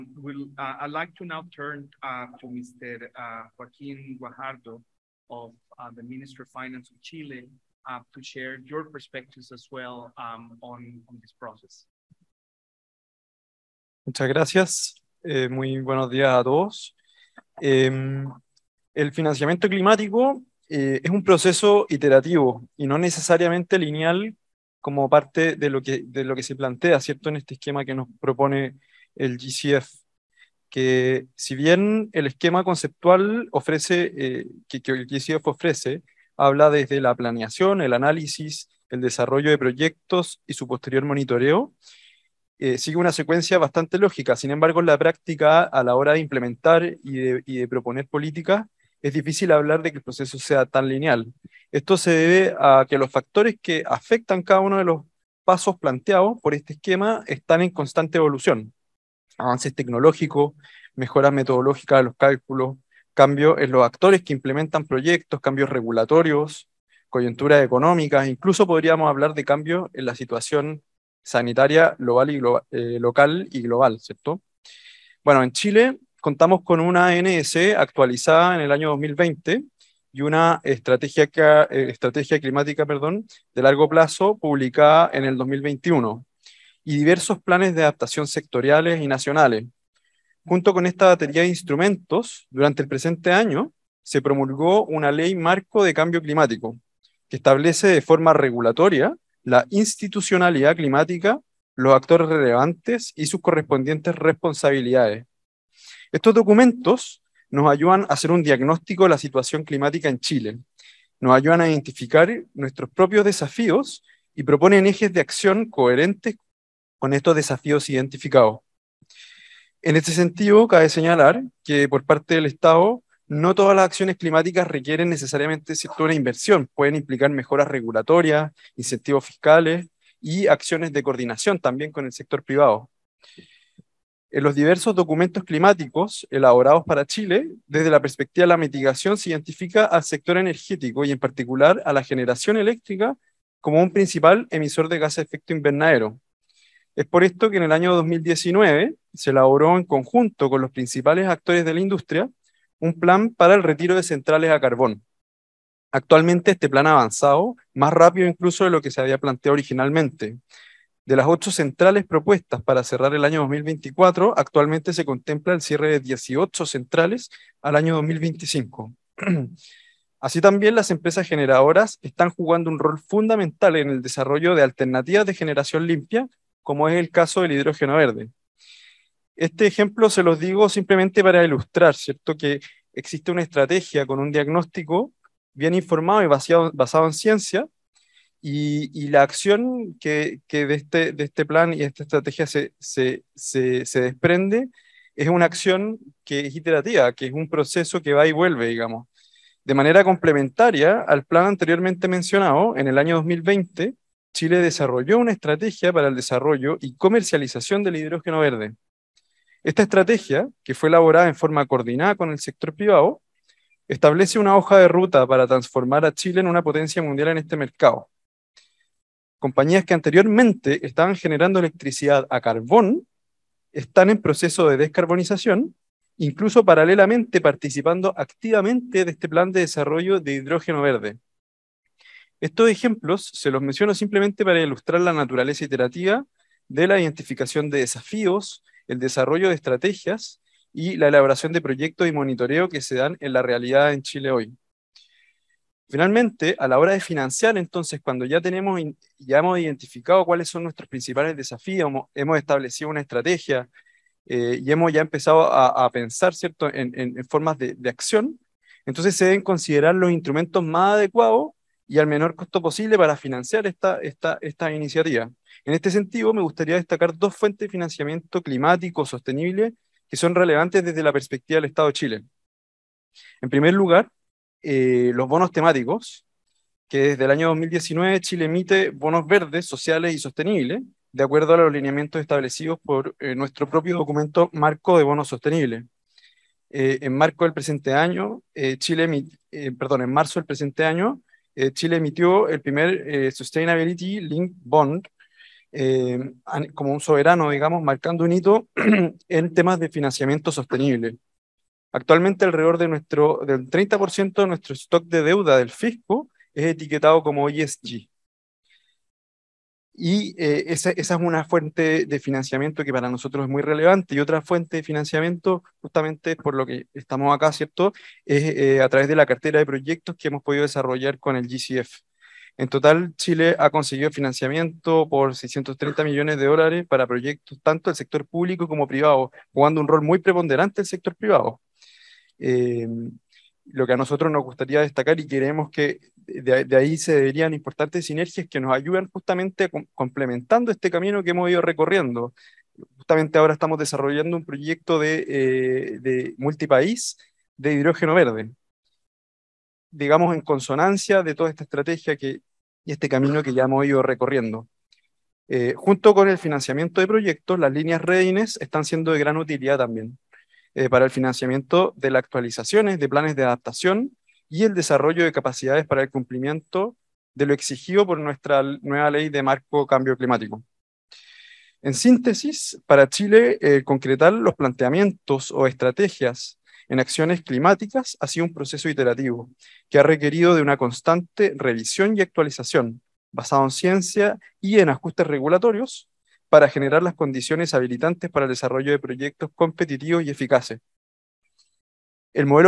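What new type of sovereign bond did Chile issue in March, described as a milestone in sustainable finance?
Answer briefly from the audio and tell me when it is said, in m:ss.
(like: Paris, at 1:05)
Sustainability Link Bond, at 4:53.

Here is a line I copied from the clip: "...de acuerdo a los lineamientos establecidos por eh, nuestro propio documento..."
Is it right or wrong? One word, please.
right.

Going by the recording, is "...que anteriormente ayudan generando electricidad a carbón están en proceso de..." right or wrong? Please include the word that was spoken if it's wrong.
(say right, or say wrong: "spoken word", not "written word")
wrong: "estaban", not "ayudan".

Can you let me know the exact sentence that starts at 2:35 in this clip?
Actualmente este plan ha avanzado más rápido incluso de lo que se había planteado originalmente.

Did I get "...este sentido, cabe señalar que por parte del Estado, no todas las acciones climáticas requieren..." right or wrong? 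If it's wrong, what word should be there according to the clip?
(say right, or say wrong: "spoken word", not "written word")
right.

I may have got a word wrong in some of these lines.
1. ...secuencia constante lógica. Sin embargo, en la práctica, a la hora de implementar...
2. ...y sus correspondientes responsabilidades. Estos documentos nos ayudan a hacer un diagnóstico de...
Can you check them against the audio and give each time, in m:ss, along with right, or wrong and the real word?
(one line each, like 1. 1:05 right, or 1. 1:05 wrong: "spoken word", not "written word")
1. 0:43 wrong: "bastante", not "constante"
2. 1:43 right.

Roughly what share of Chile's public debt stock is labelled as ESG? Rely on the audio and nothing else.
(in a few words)
30%.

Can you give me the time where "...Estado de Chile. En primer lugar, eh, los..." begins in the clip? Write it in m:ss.
4:31.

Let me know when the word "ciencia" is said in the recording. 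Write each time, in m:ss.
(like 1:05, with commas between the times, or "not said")
3:07, 6:23.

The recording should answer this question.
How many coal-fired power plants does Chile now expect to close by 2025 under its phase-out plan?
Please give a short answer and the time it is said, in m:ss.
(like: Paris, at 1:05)
18, at 2:45.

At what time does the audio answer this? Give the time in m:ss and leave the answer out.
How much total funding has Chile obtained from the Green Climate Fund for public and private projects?
5:25.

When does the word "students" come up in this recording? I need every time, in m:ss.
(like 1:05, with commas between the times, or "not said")
not said.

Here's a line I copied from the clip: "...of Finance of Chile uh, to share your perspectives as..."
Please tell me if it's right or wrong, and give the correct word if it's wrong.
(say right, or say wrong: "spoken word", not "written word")
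right.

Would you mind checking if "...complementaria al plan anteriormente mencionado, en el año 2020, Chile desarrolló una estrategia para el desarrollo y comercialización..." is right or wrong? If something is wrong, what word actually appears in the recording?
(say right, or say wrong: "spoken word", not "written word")
right.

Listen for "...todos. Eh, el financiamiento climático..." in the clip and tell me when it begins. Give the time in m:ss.
0:16.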